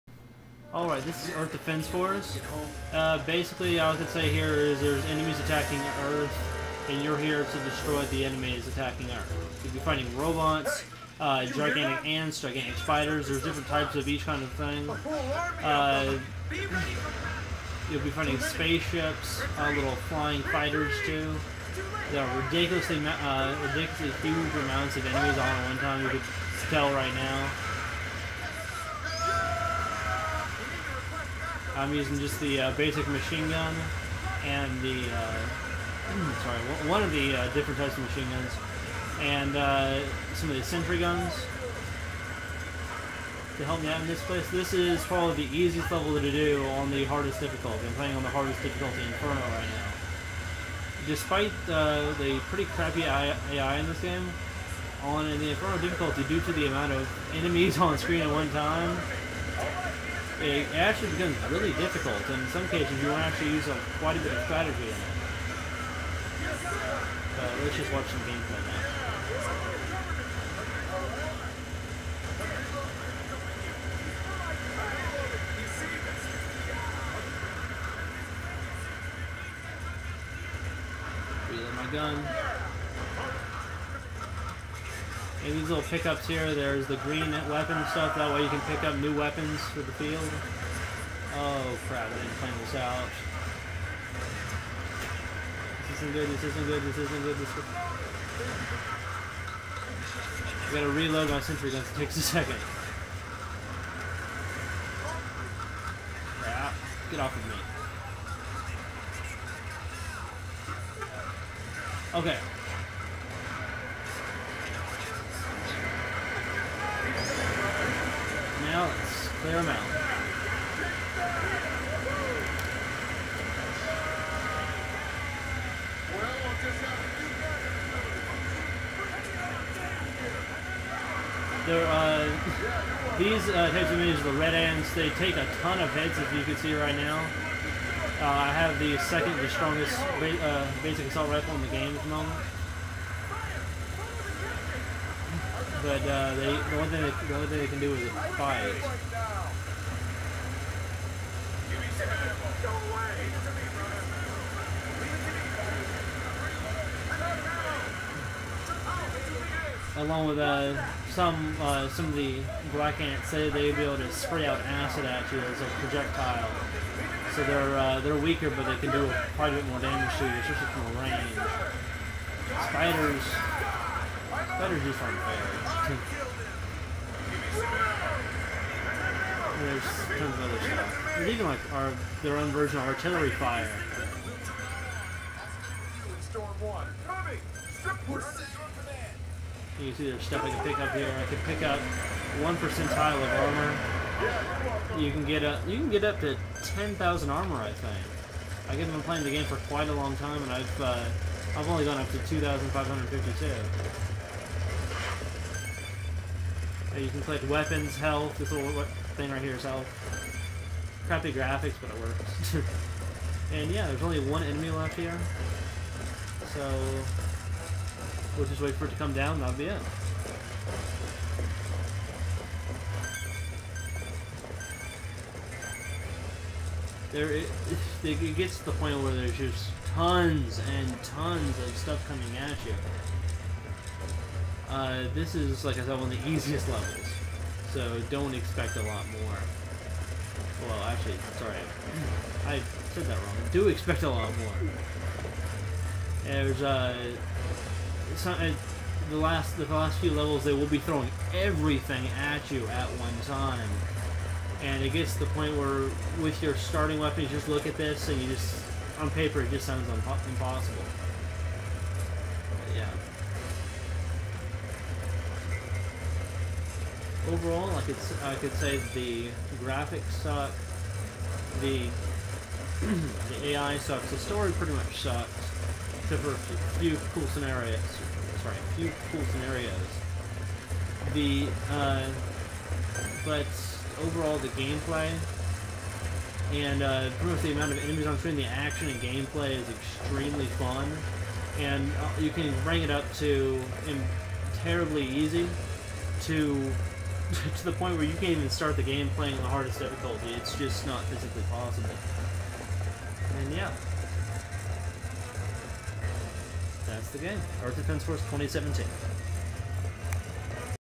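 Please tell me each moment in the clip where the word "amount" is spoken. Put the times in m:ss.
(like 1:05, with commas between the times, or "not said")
0:24, 0:56, 4:47.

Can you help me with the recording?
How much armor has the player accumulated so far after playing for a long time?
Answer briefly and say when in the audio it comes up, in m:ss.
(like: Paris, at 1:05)
2552, at 3:22.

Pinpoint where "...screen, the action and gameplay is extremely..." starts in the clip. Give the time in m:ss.
4:48.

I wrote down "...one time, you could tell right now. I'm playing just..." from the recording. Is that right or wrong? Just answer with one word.
wrong.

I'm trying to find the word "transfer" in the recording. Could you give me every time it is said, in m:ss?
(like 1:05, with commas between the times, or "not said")
not said.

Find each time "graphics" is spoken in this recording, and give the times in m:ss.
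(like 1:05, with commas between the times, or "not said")
3:31, 4:29.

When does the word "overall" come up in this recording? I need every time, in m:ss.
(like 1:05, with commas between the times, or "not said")
4:27, 4:44.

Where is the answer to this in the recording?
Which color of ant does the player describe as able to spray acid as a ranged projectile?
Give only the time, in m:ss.
2:42.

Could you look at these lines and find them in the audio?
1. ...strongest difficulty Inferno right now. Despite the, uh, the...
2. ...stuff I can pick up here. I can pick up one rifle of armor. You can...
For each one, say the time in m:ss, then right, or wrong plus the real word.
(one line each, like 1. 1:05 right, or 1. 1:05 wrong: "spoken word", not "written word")
1. 0:48 wrong: "hardest", not "strongest"
2. 3:10 wrong: "percentile", not "rifle".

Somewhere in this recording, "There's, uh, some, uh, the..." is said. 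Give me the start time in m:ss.
4:06.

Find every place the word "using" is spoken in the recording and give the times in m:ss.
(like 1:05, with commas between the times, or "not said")
0:31.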